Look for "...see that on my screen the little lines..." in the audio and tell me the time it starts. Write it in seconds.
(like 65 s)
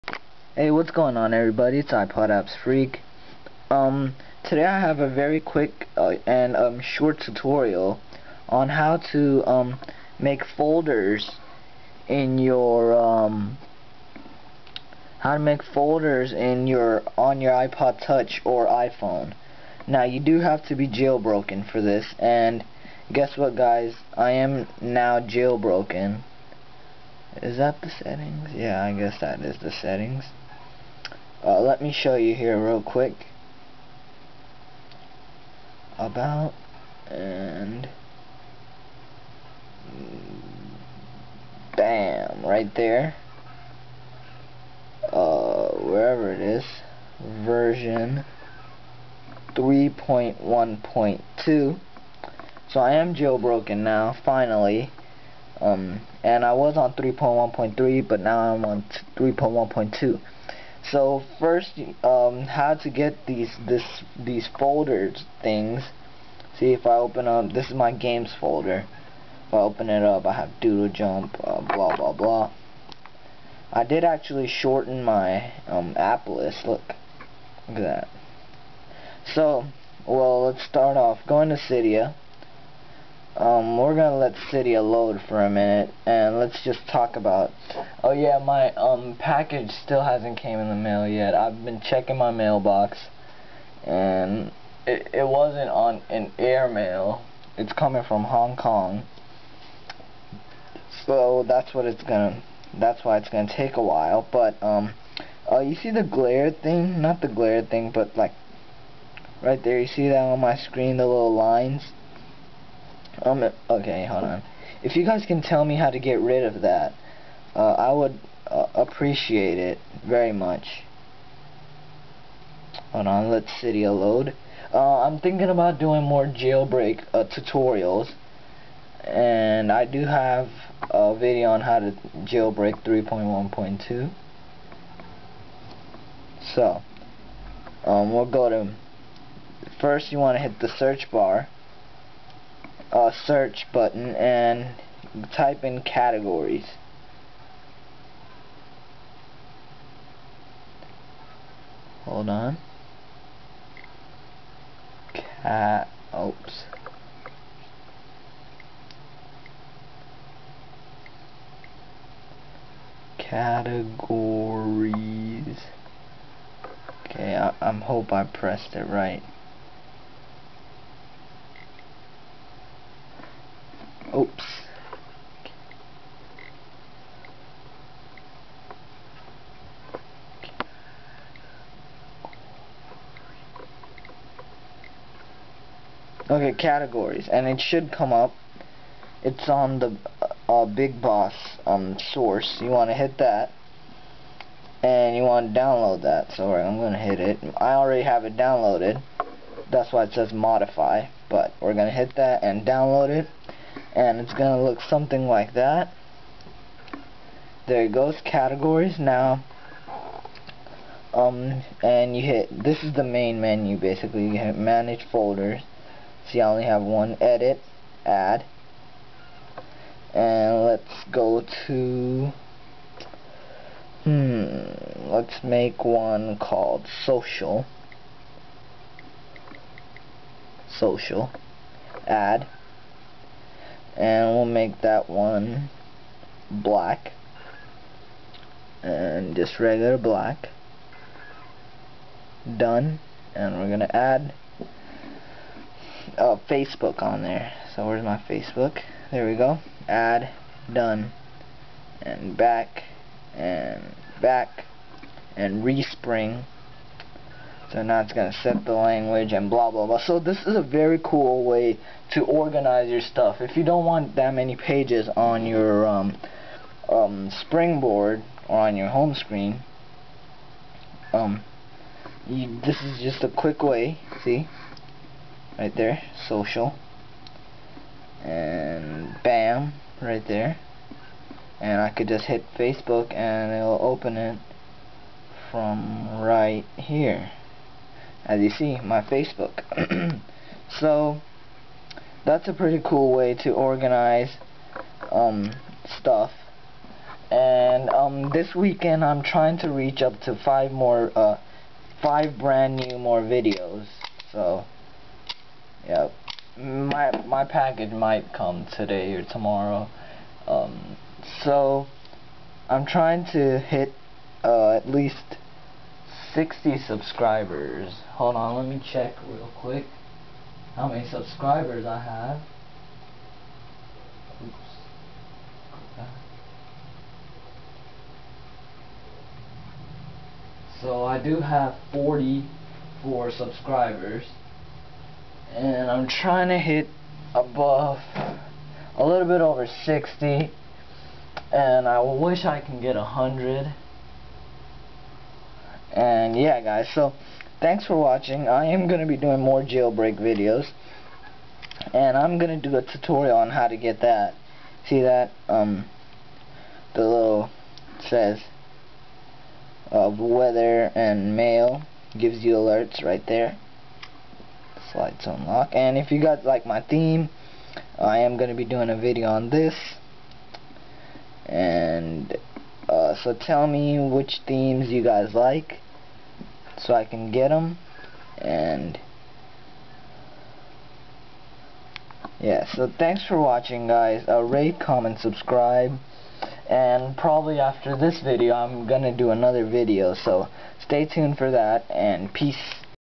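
109 s.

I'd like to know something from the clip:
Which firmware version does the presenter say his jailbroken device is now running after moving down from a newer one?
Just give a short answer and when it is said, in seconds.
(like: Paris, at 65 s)
3.1.2, at 47 s.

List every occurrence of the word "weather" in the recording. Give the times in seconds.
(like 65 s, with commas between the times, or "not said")
360 s.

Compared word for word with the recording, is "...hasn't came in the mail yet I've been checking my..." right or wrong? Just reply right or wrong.
right.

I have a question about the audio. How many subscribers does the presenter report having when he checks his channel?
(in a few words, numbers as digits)
44.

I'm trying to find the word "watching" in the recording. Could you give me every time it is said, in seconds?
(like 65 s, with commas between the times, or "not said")
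347 s, 383 s.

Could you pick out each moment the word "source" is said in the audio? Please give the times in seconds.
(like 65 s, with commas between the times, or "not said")
192 s.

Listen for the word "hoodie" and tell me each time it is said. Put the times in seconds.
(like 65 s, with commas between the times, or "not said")
not said.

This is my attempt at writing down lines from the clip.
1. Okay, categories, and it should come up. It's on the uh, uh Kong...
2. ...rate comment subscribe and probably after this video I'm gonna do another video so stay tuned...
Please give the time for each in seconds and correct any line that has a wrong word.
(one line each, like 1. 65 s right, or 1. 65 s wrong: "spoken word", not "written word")
1. 186 s wrong: "Big", not "Kong"
2. 384 s right.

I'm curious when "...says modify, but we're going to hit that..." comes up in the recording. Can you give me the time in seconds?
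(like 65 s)
200 s.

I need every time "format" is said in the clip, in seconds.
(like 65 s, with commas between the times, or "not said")
not said.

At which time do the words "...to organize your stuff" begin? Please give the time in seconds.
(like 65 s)
262 s.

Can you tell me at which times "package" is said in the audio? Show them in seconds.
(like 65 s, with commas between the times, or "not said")
89 s, 307 s.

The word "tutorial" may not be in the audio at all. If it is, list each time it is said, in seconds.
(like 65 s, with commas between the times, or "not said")
7 s, 127 s, 352 s.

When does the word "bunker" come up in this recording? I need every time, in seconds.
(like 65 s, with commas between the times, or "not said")
not said.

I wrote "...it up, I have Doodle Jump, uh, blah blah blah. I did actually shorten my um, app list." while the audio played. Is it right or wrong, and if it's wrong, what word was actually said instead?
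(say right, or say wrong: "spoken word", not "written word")
right.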